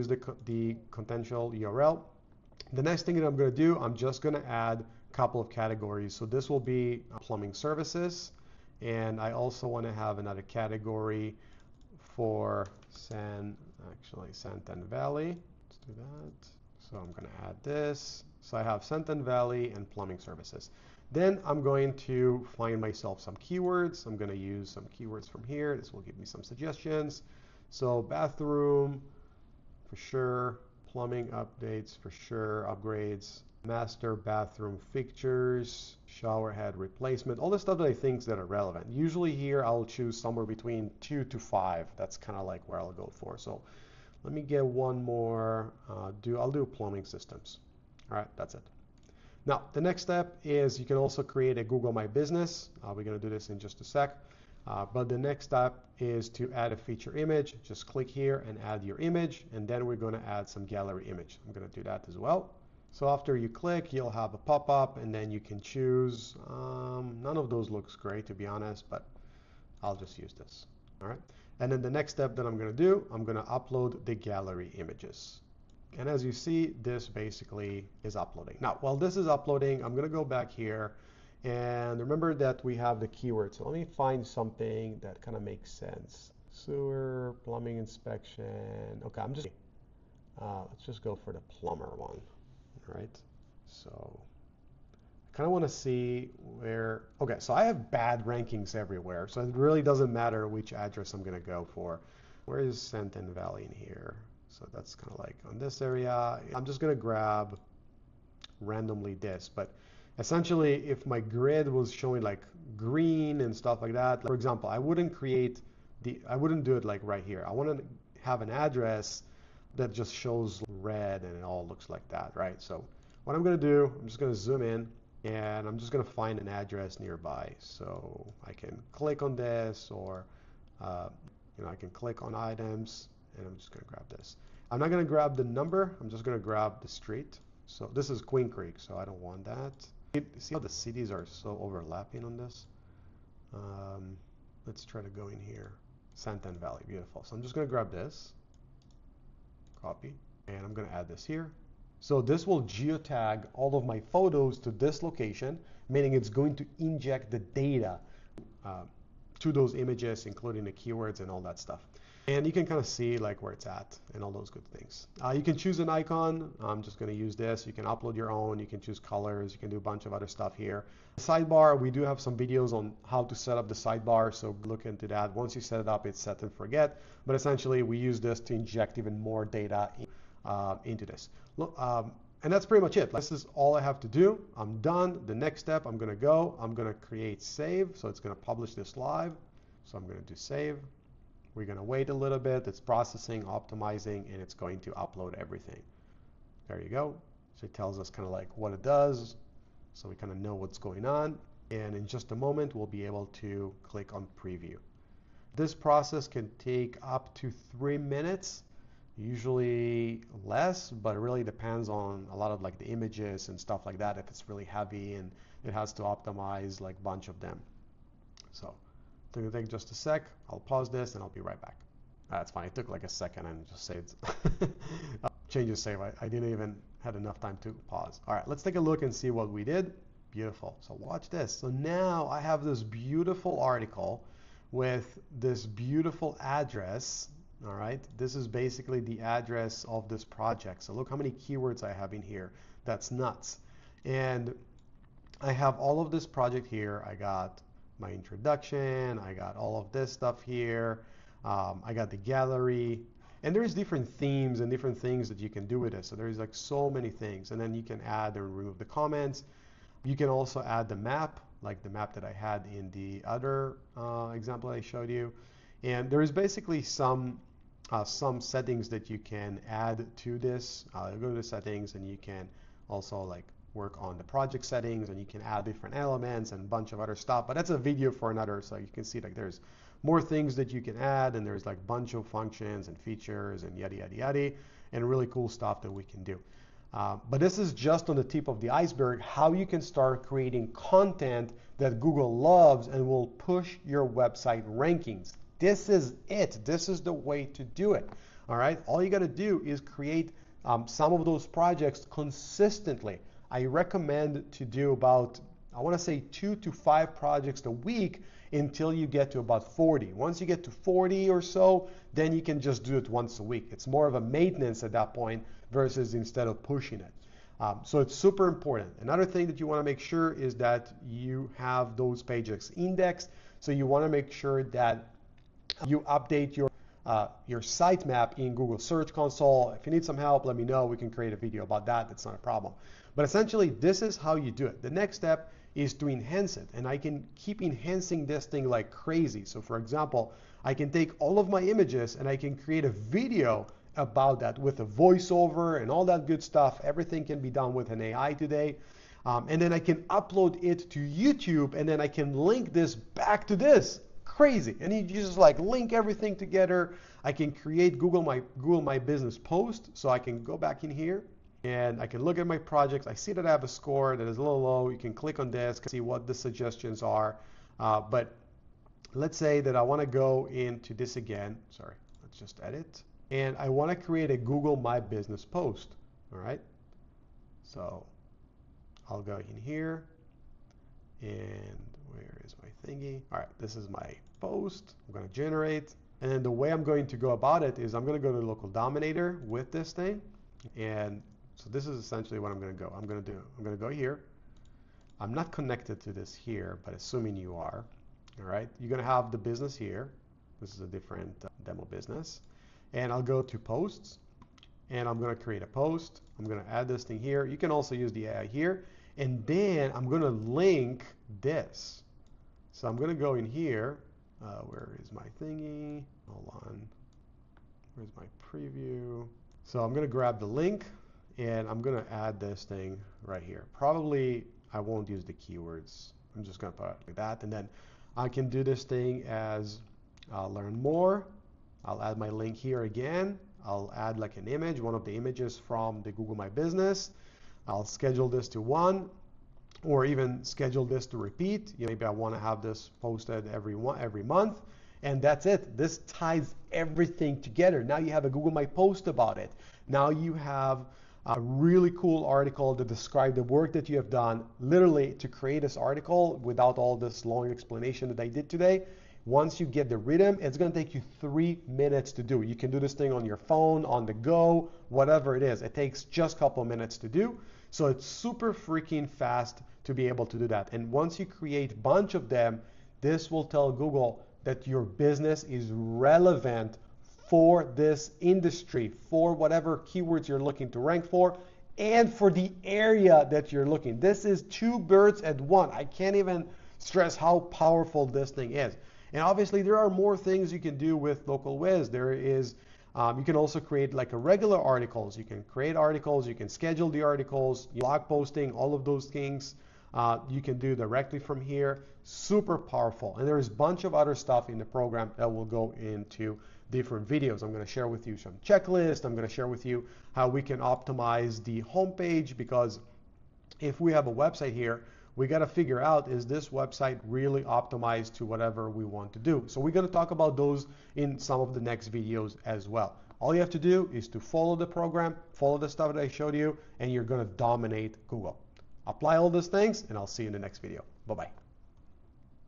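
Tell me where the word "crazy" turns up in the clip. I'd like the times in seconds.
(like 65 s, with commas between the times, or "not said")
338 s, 354 s.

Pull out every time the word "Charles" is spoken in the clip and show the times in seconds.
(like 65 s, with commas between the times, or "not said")
not said.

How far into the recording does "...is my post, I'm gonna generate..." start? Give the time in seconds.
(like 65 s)
383 s.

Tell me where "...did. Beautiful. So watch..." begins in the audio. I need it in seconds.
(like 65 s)
229 s.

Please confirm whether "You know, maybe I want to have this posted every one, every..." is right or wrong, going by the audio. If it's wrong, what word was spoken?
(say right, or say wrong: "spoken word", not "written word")
right.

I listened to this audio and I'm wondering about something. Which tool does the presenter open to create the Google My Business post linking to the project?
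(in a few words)
Local Dominator.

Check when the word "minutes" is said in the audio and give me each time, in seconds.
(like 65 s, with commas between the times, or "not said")
207 s, 461 s, 466 s.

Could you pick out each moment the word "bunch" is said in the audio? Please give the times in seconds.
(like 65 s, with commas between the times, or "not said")
169 s, 217 s, 276 s, 281 s, 471 s, 503 s.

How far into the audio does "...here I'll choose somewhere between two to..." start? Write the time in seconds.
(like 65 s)
39 s.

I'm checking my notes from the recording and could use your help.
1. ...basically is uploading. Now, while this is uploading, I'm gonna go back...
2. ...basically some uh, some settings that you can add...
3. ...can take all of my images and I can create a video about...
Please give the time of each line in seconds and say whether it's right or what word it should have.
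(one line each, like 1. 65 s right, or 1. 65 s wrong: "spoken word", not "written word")
1. 77 s right
2. 266 s right
3. 340 s right.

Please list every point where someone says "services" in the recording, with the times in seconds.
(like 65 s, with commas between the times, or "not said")
7 s, 20 s.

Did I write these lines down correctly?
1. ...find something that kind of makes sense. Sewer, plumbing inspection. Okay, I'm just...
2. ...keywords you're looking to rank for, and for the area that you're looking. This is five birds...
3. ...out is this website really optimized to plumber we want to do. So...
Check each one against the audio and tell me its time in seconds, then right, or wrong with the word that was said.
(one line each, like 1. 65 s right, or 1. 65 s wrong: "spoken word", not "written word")
1. 83 s right
2. 479 s wrong: "two", not "five"
3. 515 s wrong: "whatever", not "plumber".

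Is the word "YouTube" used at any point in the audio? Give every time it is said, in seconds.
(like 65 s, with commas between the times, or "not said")
351 s.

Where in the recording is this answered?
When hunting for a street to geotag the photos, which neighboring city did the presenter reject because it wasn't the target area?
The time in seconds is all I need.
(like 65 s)
138 s.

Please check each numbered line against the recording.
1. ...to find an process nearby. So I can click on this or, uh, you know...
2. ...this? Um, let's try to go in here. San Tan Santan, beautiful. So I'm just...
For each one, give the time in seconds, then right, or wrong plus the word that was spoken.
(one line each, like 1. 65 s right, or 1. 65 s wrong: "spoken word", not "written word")
1. 126 s wrong: "address", not "process"
2. 142 s wrong: "Valley", not "Santan".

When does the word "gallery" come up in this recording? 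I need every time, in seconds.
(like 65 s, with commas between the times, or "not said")
60 s, 74 s, 252 s.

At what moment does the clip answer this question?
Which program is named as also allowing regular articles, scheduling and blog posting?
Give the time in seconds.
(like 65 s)
491 s.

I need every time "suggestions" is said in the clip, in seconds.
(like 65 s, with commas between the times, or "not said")
26 s, 366 s.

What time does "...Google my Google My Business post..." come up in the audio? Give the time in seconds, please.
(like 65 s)
357 s.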